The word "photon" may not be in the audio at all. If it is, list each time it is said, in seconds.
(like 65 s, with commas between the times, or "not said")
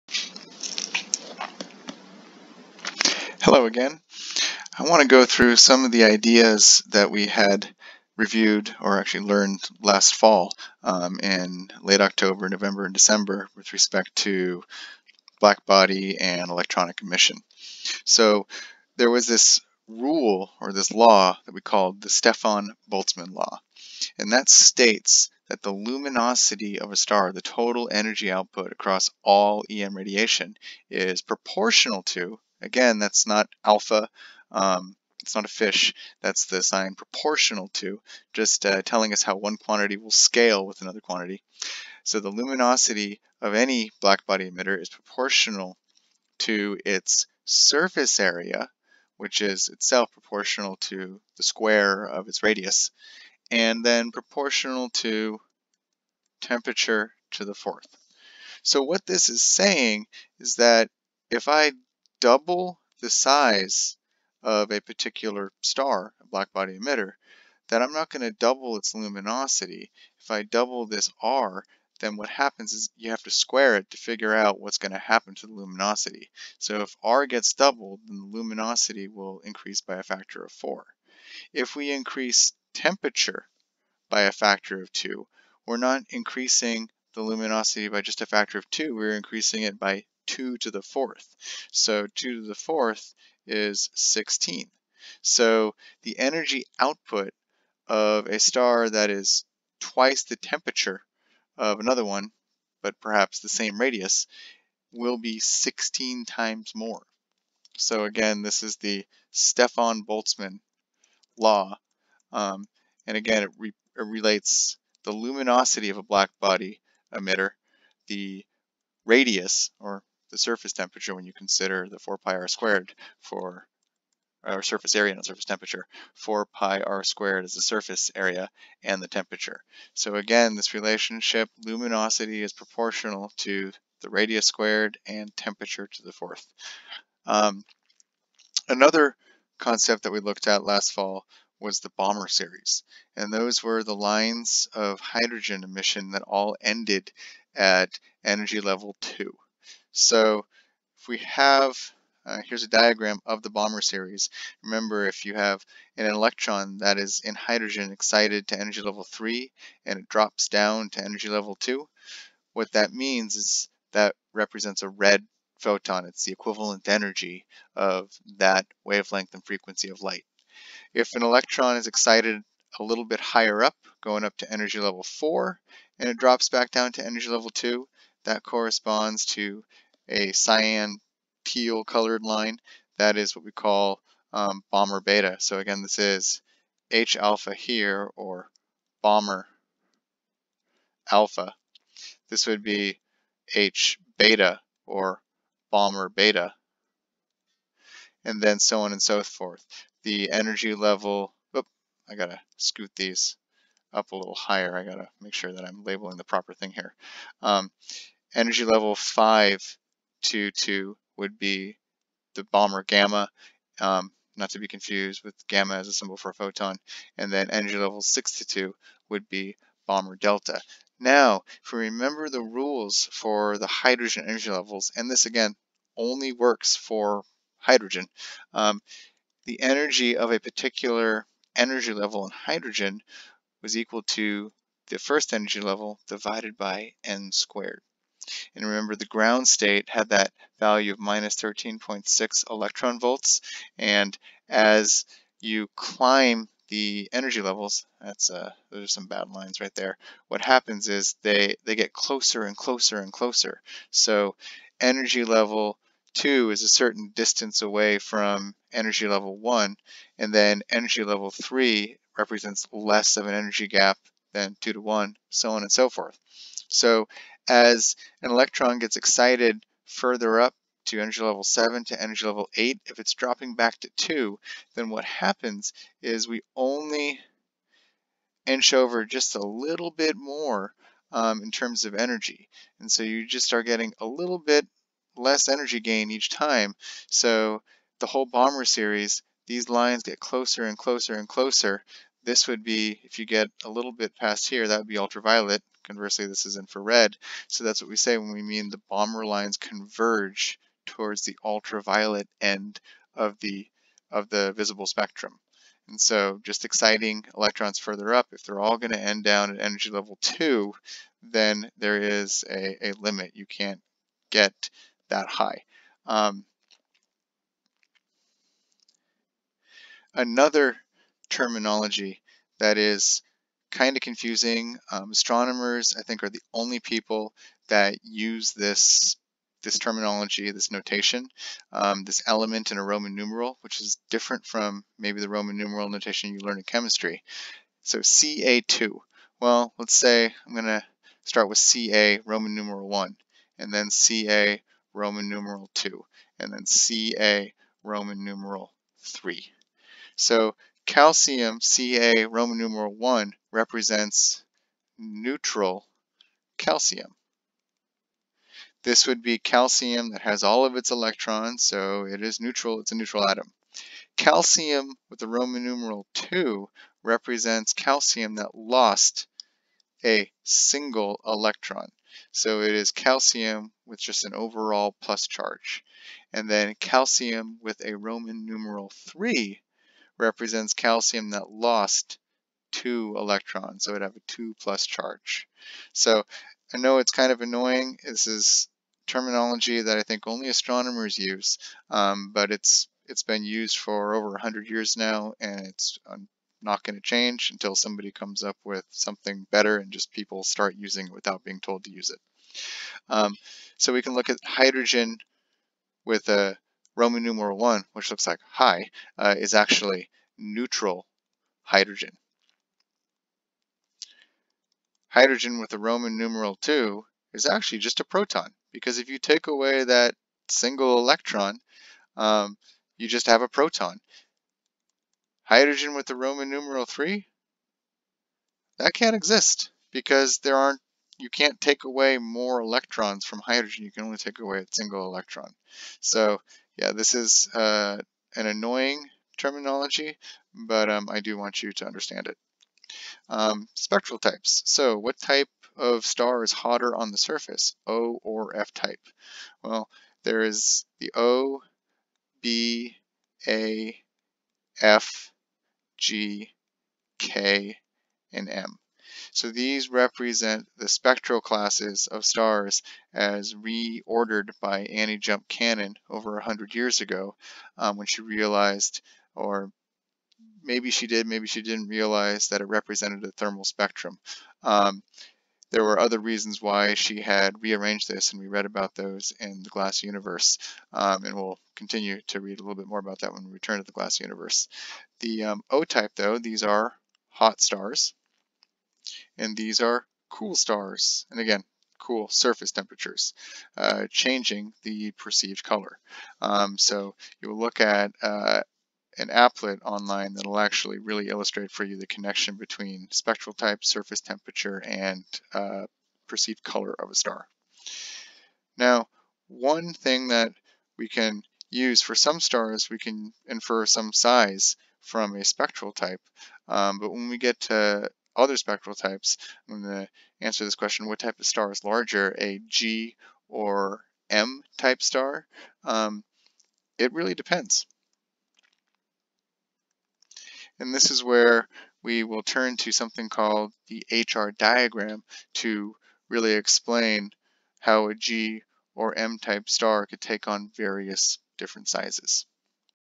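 165 s, 216 s.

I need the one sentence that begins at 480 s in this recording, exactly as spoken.
Um, and we'll continue to read a little bit more about that when we return to the glass universe.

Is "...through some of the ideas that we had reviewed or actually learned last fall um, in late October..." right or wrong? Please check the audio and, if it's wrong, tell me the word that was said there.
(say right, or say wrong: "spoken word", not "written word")
right.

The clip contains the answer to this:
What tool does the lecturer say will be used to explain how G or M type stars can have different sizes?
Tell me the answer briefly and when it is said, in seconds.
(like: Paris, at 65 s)
HR diagram, at 534 s.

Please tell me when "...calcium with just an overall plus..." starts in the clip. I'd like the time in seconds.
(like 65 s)
372 s.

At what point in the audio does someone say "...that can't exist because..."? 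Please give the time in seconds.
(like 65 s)
428 s.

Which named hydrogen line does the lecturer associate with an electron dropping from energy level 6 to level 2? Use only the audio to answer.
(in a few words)
Balmer delta.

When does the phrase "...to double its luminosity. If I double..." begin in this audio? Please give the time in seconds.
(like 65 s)
68 s.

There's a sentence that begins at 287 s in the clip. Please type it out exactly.
So the whole Balmer series, these lines get closer and closer and closer.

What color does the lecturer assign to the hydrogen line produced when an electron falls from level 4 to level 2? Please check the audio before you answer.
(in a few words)
cyan teal.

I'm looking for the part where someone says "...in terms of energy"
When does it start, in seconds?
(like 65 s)
281 s.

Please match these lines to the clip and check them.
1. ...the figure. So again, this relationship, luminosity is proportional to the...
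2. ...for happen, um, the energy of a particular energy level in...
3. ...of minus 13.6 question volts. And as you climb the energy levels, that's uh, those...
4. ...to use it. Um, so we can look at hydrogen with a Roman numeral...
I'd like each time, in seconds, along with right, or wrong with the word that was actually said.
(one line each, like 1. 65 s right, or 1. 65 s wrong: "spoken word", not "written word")
1. 129 s wrong: "temperature", not "figure"
2. 226 s wrong: "hydrogen", not "happen"
3. 240 s wrong: "electron", not "question"
4. 401 s right.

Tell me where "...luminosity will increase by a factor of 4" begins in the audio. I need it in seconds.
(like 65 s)
78 s.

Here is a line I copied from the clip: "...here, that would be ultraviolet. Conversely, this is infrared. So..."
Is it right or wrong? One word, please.
right.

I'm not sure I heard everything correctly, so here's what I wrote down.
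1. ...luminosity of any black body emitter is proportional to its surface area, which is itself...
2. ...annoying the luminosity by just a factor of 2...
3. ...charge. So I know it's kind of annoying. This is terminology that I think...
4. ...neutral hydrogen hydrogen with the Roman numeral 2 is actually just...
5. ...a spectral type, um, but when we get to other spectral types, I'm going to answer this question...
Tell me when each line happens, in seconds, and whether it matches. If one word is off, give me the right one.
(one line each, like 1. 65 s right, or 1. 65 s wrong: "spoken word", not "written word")
1. 42 s right
2. 86 s wrong: "increasing", not "annoying"
3. 384 s right
4. 410 s right
5. 515 s right.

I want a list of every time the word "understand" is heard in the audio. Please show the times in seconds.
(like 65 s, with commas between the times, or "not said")
441 s.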